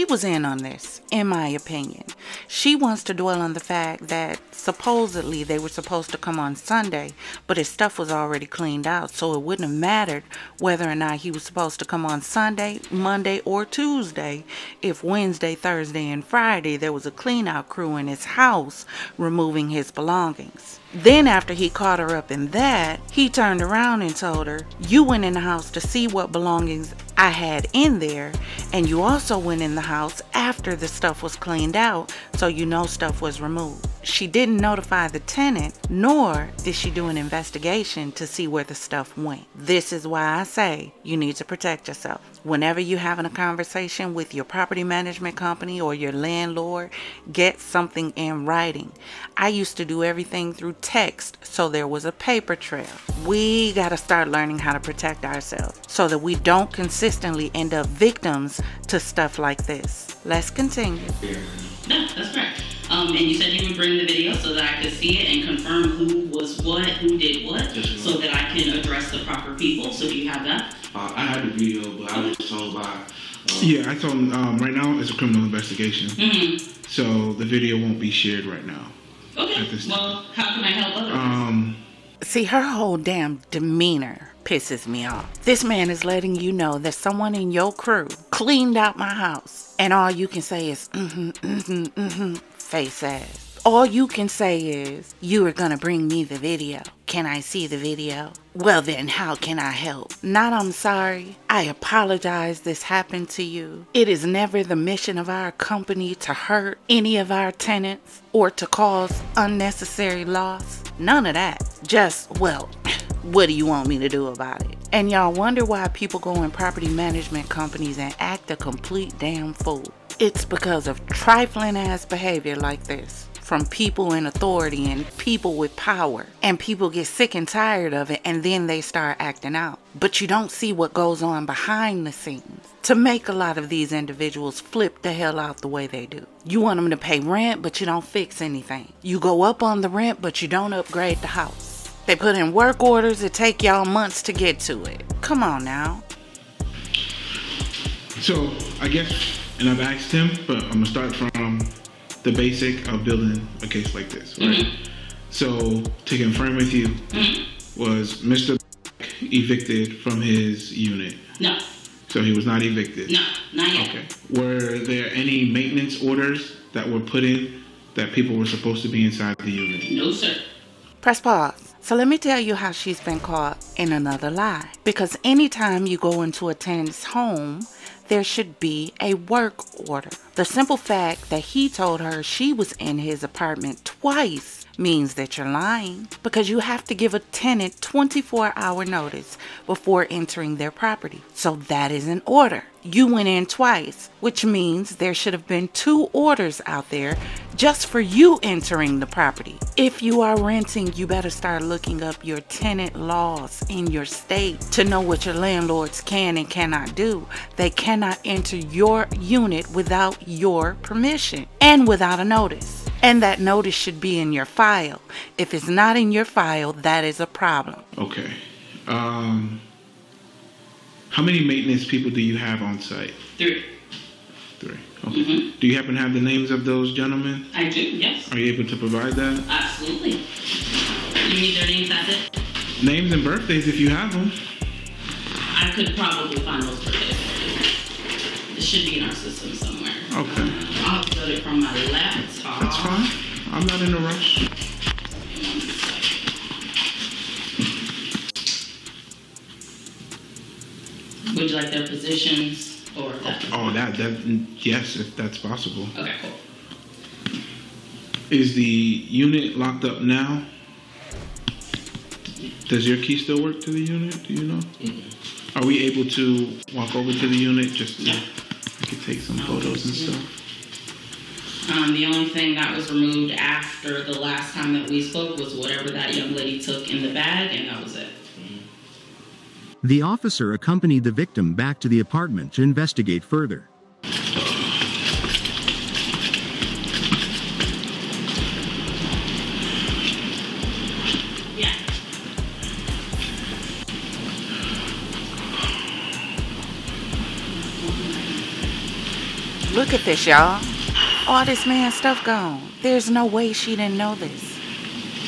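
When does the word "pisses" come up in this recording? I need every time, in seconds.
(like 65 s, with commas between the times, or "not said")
84 s.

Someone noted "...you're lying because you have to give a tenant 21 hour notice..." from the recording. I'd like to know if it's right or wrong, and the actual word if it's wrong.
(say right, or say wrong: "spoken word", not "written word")
wrong: "24", not "21".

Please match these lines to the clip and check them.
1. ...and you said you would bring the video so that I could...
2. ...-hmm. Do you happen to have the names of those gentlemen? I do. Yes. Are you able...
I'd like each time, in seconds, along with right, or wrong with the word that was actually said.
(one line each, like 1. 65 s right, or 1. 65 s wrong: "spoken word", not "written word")
1. 63 s right
2. 225 s right.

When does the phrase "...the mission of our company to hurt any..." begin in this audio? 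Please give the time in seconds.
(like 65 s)
104 s.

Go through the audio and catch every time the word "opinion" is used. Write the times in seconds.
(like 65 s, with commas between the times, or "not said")
1 s.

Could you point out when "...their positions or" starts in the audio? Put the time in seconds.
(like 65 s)
251 s.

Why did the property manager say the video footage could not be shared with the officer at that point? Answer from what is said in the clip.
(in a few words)
Criminal investigation.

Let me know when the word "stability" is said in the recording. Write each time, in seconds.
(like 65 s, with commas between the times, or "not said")
not said.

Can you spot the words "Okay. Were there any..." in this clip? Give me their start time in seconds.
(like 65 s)
163 s.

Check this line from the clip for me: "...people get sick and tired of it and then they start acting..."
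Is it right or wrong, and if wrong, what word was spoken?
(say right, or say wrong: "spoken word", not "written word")
right.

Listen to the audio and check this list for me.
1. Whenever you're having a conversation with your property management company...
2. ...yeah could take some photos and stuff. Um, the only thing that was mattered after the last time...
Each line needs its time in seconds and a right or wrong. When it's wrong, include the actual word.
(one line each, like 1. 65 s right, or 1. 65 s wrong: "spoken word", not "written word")
1. 42 s right
2. 268 s wrong: "removed", not "mattered".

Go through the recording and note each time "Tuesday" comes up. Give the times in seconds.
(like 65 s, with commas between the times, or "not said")
13 s.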